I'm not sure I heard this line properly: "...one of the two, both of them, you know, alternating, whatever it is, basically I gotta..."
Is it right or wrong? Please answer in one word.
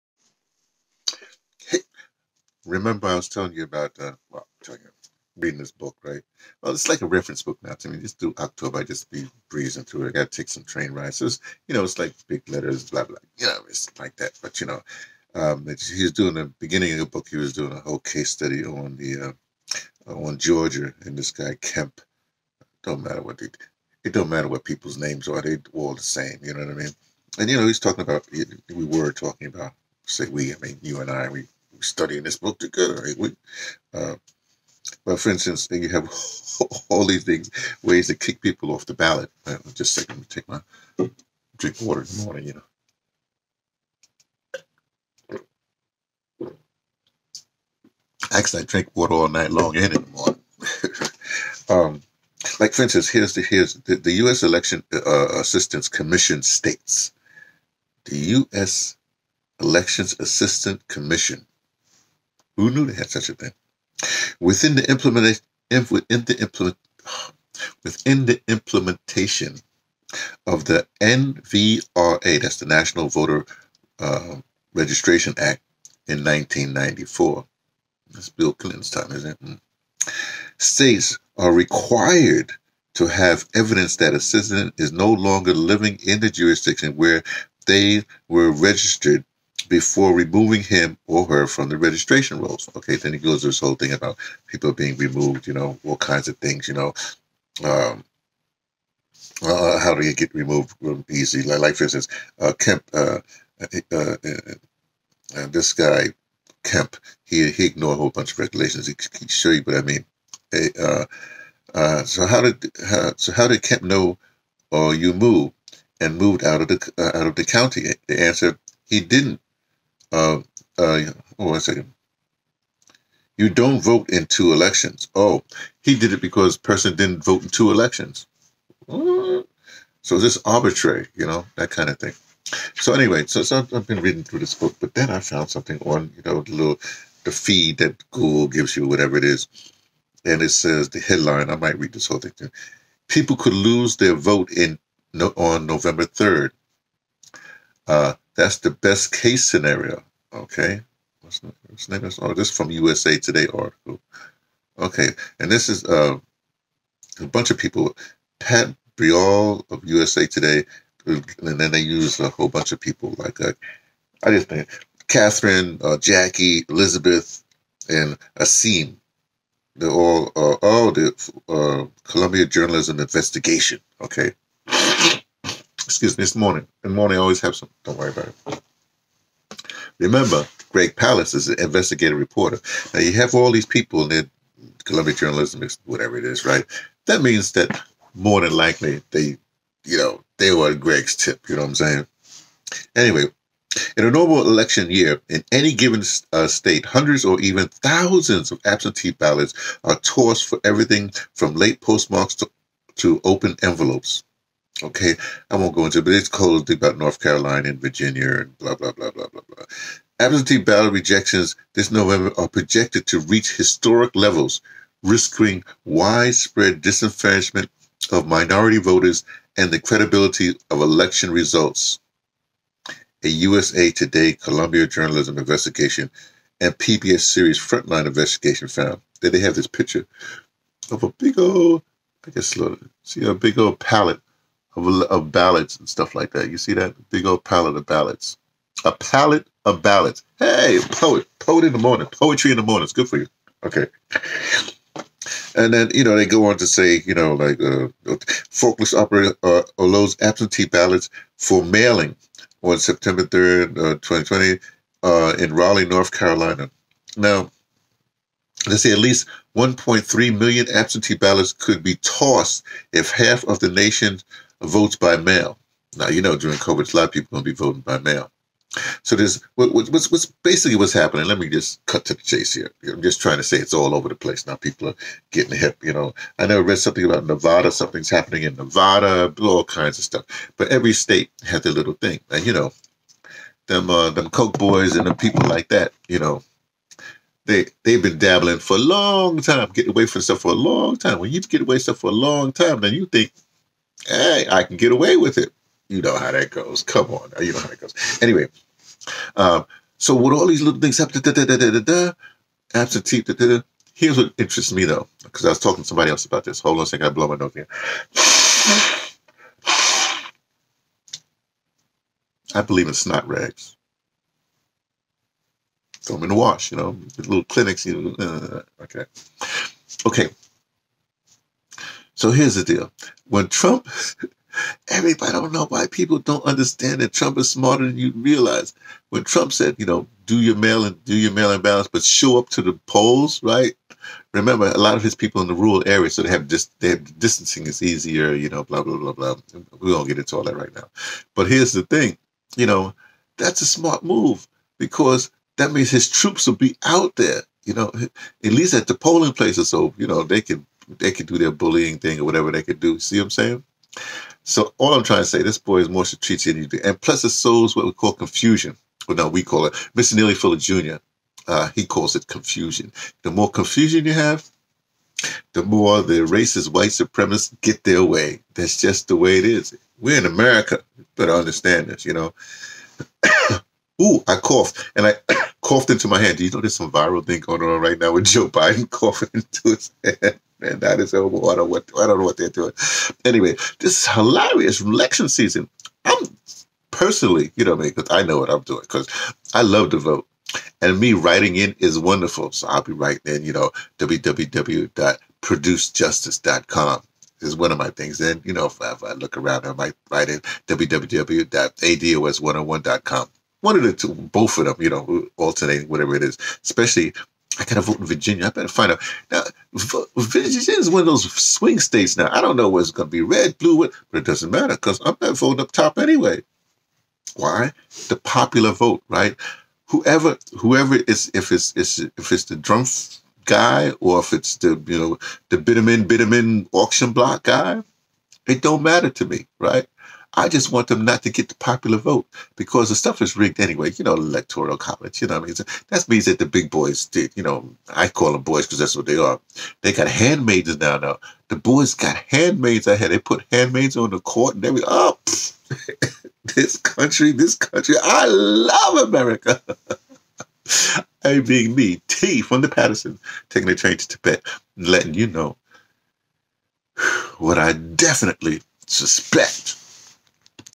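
wrong.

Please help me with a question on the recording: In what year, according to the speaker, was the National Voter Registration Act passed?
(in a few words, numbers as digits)
1994.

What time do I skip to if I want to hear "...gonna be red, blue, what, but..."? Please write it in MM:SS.
06:52.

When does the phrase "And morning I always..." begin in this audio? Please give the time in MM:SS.
02:56.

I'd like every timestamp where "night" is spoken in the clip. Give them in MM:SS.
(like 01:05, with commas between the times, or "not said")
00:49.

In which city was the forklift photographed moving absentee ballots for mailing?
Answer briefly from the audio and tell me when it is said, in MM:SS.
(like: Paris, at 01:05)
Raleigh, at 04:15.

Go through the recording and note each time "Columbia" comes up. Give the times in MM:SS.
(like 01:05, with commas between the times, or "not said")
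02:52, 03:04, 03:44.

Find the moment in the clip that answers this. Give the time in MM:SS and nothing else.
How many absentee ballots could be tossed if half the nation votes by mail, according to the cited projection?
04:19.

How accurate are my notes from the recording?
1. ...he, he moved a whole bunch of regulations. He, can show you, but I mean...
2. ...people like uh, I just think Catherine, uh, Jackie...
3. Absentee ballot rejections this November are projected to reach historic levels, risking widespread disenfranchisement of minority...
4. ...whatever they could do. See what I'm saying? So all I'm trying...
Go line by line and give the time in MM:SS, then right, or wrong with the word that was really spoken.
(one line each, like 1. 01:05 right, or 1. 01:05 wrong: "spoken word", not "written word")
1. 01:47 wrong: "ignored", not "moved"
2. 02:42 right
3. 03:30 right
4. 05:52 right.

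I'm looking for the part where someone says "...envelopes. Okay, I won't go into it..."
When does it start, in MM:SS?
03:23.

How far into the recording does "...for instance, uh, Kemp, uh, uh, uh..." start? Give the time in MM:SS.
01:41.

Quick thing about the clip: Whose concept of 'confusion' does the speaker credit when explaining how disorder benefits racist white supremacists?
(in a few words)
Neely Fuller Jr.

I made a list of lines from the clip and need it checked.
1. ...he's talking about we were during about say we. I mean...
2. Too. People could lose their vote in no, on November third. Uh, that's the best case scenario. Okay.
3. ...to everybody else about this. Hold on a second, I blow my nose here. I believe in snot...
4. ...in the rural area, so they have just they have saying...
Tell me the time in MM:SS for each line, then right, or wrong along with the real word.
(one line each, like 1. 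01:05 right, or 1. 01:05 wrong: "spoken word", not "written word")
1. 00:27 wrong: "talking", not "during"
2. 02:22 right
3. 05:05 wrong: "somebody", not "everybody"
4. 05:35 wrong: "distancing", not "saying".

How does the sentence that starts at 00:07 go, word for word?
Just through October, I just be breezing through it.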